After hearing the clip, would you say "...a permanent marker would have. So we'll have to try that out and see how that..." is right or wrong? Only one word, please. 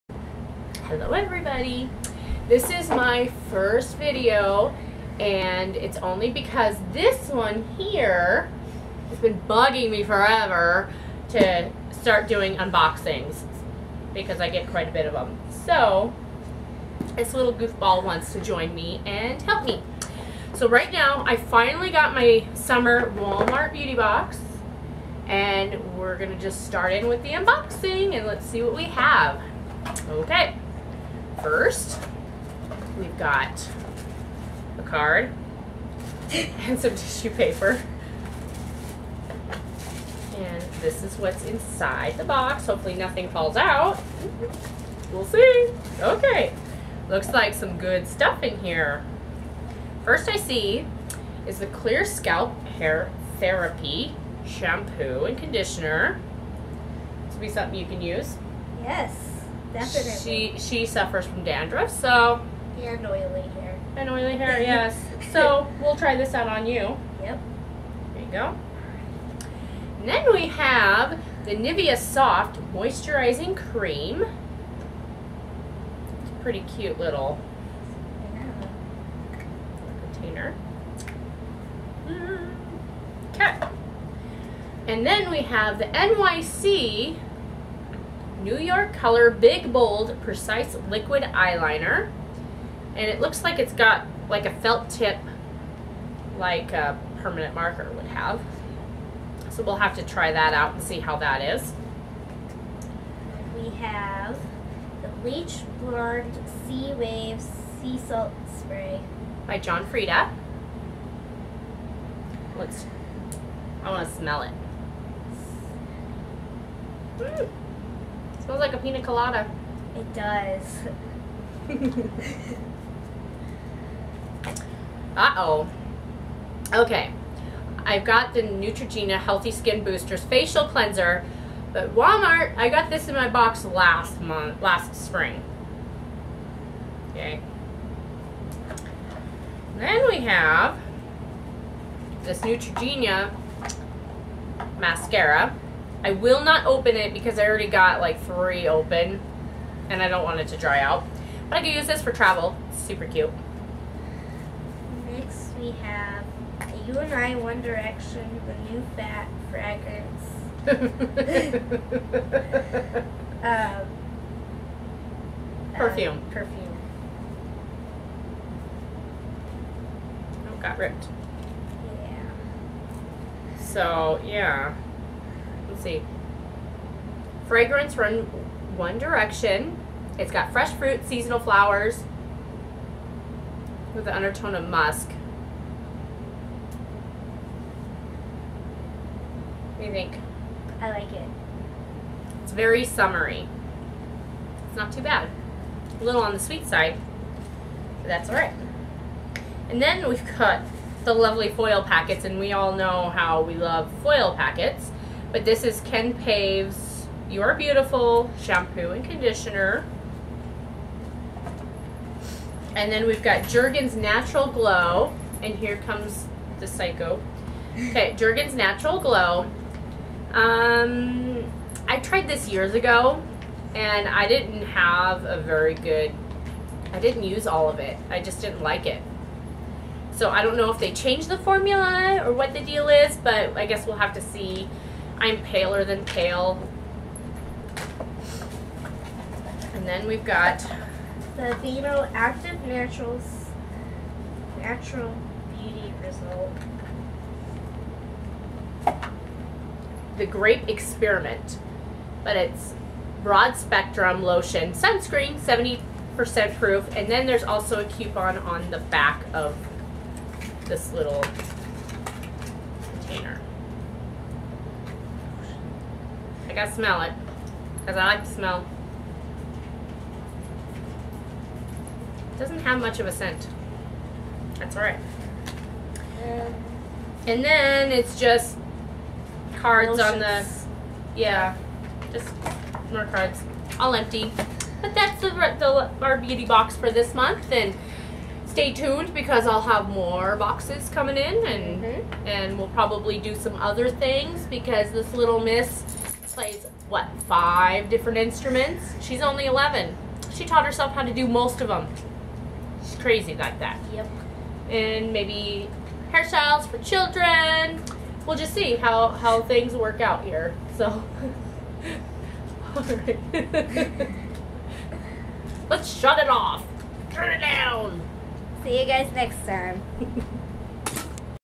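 right.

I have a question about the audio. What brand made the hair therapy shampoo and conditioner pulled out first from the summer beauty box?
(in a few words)
Clear Scalp.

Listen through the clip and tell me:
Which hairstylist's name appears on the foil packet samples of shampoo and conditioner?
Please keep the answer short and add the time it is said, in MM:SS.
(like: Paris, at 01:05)
Ken Paves, at 03:25.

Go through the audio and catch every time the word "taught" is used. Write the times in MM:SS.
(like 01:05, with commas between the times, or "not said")
05:00.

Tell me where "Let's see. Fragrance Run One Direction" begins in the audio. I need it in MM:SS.
02:55.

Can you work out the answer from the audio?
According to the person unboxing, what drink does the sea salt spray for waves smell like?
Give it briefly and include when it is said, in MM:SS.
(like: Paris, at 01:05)
Pina colada, at 01:58.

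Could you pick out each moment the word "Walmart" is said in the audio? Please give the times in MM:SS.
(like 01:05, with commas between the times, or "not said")
00:23, 02:11.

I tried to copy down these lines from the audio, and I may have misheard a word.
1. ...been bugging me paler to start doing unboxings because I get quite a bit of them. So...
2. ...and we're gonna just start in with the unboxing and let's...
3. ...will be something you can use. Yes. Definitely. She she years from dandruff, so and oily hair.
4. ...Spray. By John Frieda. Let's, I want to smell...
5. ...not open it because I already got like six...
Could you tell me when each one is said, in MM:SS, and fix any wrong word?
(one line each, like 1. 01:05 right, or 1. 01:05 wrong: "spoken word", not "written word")
1. 00:09 wrong: "forever", not "paler"
2. 00:25 right
3. 00:57 wrong: "suffers", not "years"
4. 01:48 right
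5. 02:26 wrong: "three", not "six".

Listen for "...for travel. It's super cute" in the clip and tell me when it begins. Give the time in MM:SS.
02:32.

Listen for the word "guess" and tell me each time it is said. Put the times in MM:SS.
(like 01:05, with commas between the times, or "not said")
03:53.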